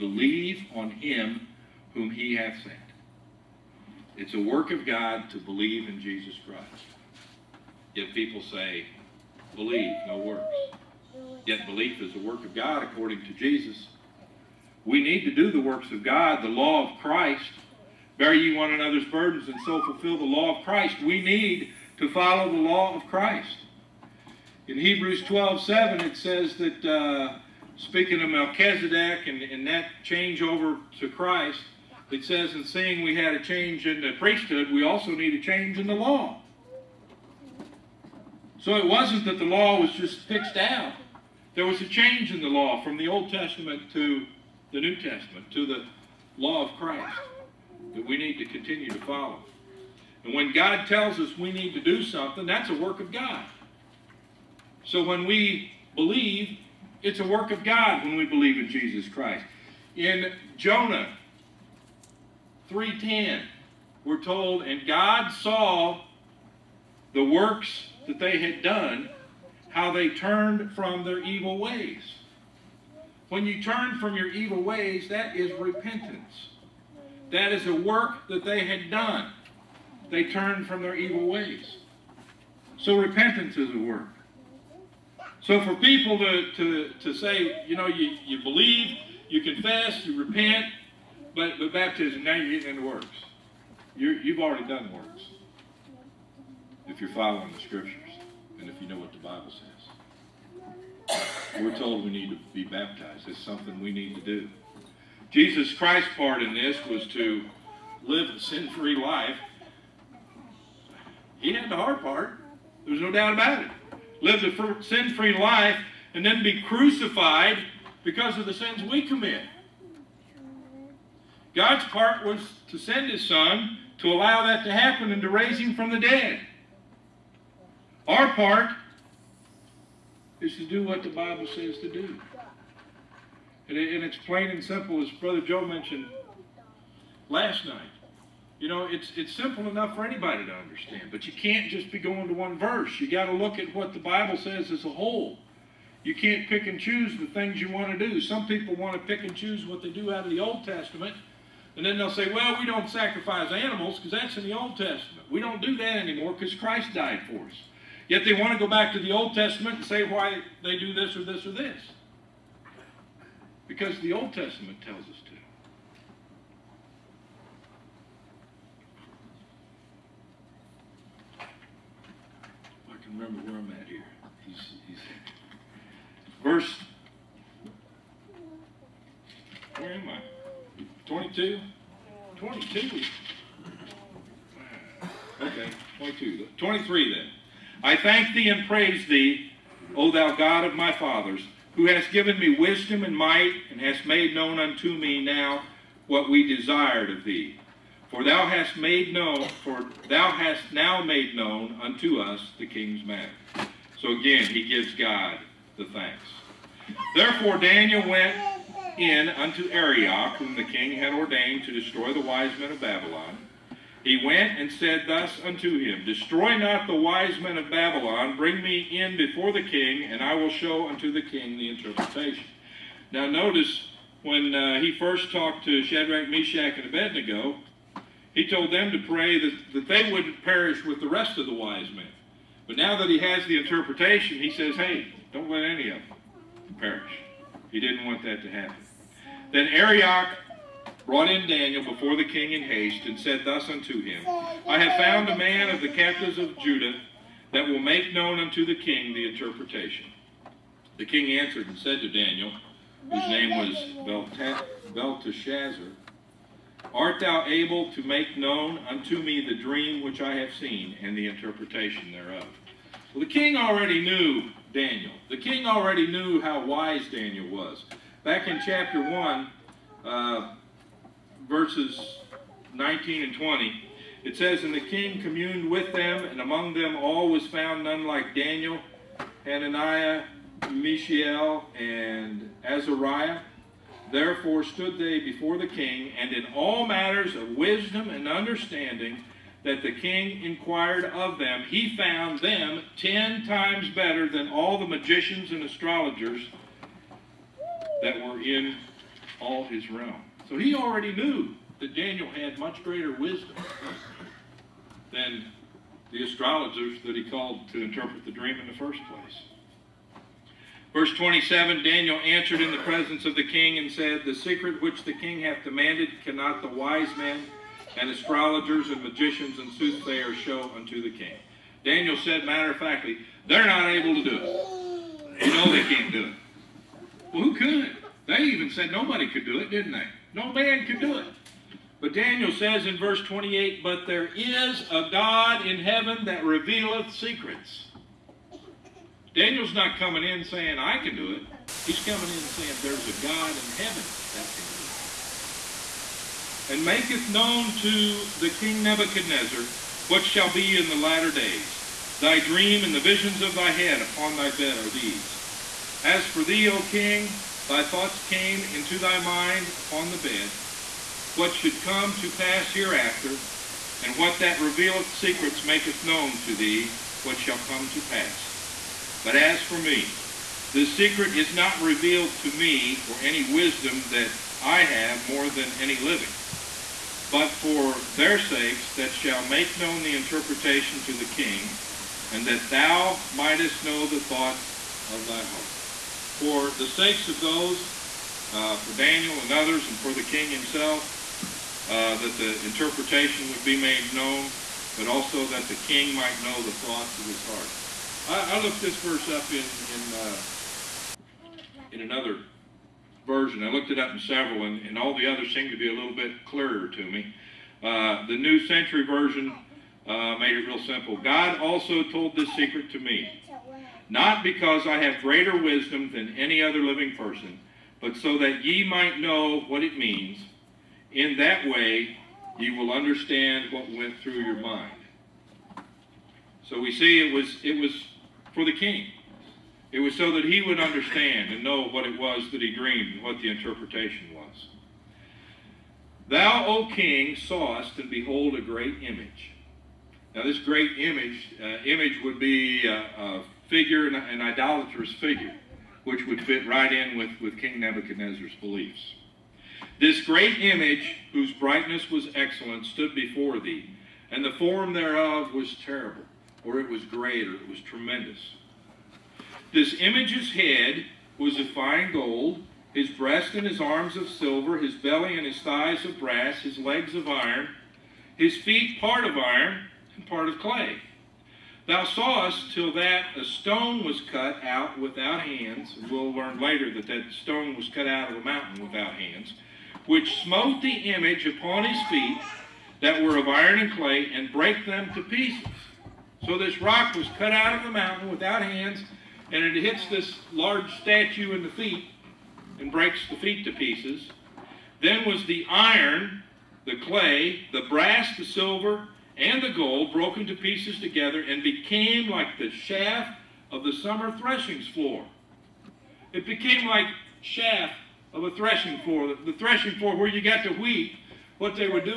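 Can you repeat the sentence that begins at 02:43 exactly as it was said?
Because the Old Testament tells us to.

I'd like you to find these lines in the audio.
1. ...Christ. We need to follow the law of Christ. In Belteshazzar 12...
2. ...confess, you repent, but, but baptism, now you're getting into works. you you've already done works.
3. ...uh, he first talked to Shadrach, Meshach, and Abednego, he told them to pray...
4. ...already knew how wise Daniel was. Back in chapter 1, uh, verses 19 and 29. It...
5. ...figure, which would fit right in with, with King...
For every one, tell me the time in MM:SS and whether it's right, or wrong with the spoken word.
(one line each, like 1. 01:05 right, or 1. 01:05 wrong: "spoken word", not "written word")
1. 00:20 wrong: "Hebrews", not "Belteshazzar"
2. 01:29 right
3. 03:44 right
4. 04:25 wrong: "20", not "29"
5. 07:25 right.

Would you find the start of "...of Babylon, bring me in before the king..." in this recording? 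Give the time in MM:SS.
03:37.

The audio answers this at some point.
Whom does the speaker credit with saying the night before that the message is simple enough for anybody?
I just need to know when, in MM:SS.
02:15.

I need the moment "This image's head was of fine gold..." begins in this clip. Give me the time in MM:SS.
07:39.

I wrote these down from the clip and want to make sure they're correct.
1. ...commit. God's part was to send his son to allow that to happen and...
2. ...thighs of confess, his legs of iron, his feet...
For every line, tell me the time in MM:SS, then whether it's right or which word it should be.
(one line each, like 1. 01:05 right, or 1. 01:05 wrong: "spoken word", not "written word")
1. 01:59 right
2. 07:45 wrong: "brass", not "confess".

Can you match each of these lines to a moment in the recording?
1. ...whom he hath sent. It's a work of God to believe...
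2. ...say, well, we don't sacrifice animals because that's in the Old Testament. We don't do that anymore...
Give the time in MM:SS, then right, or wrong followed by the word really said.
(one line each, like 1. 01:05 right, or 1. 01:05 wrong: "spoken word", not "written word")
1. 00:01 right
2. 02:32 right.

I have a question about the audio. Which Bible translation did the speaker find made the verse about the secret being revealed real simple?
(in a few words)
New Century Version.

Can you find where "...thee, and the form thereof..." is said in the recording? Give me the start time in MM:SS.
07:33.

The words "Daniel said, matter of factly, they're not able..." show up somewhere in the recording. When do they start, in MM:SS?
05:21.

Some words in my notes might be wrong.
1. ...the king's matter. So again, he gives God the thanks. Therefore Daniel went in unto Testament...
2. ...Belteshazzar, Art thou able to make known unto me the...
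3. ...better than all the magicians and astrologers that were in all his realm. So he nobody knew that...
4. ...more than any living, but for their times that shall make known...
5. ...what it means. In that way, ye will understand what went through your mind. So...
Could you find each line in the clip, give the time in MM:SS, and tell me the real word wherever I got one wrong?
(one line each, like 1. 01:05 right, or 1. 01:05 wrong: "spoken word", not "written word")
1. 03:22 wrong: "Arioch", not "Testament"
2. 04:14 right
3. 04:53 wrong: "already", not "nobody"
4. 06:15 wrong: "sakes", not "times"
5. 06:59 right.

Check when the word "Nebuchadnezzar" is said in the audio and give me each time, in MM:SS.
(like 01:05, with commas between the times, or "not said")
05:48, 07:27.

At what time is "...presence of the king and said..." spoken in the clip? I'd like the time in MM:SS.
05:12.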